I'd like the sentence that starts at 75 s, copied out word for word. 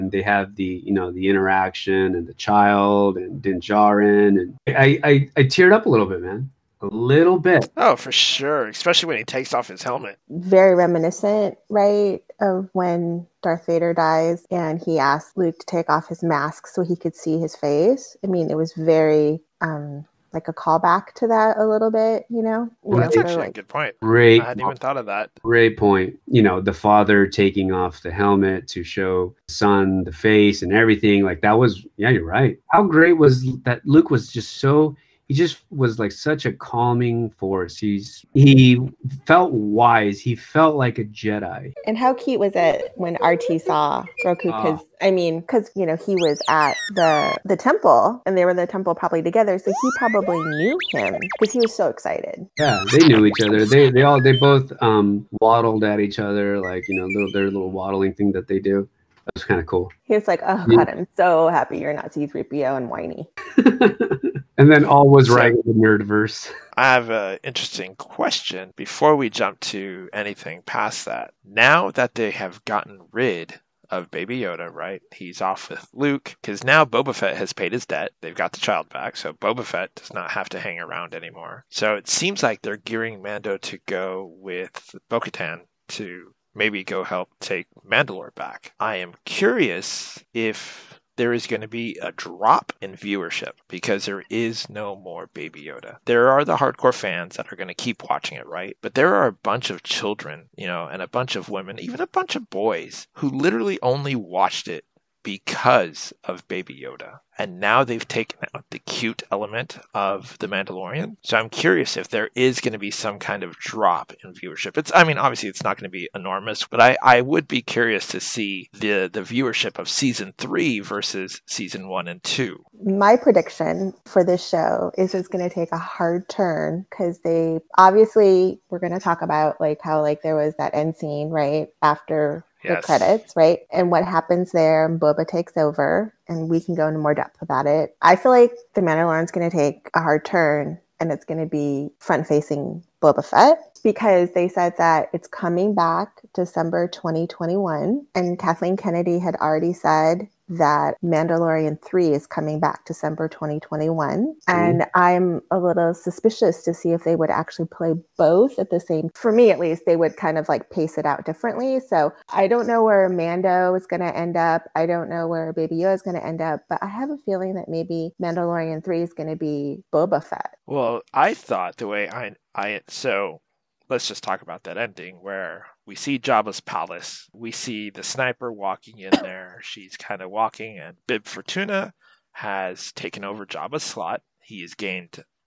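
He's off with Luke because now Boba Fett has paid his debt.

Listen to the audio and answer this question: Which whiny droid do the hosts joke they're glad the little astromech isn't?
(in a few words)
C-3PO.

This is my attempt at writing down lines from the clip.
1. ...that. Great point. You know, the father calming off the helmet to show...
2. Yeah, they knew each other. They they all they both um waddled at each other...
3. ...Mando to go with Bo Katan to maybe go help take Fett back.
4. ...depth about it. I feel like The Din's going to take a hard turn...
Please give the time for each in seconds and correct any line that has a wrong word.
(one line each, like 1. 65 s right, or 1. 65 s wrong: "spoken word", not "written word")
1. 25 s wrong: "taking", not "calming"
2. 52 s right
3. 83 s wrong: "Mandalore", not "Fett"
4. 137 s wrong: "Mandalorian", not "Din".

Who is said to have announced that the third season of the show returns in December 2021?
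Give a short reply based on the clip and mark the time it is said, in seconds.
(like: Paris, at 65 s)
Kathleen Kennedy, at 148 s.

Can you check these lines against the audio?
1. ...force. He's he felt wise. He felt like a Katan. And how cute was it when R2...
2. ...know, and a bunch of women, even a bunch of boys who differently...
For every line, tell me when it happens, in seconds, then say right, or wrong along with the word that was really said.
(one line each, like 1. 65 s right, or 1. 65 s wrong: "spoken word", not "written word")
1. 37 s wrong: "Jedi", not "Katan"
2. 100 s wrong: "literally", not "differently".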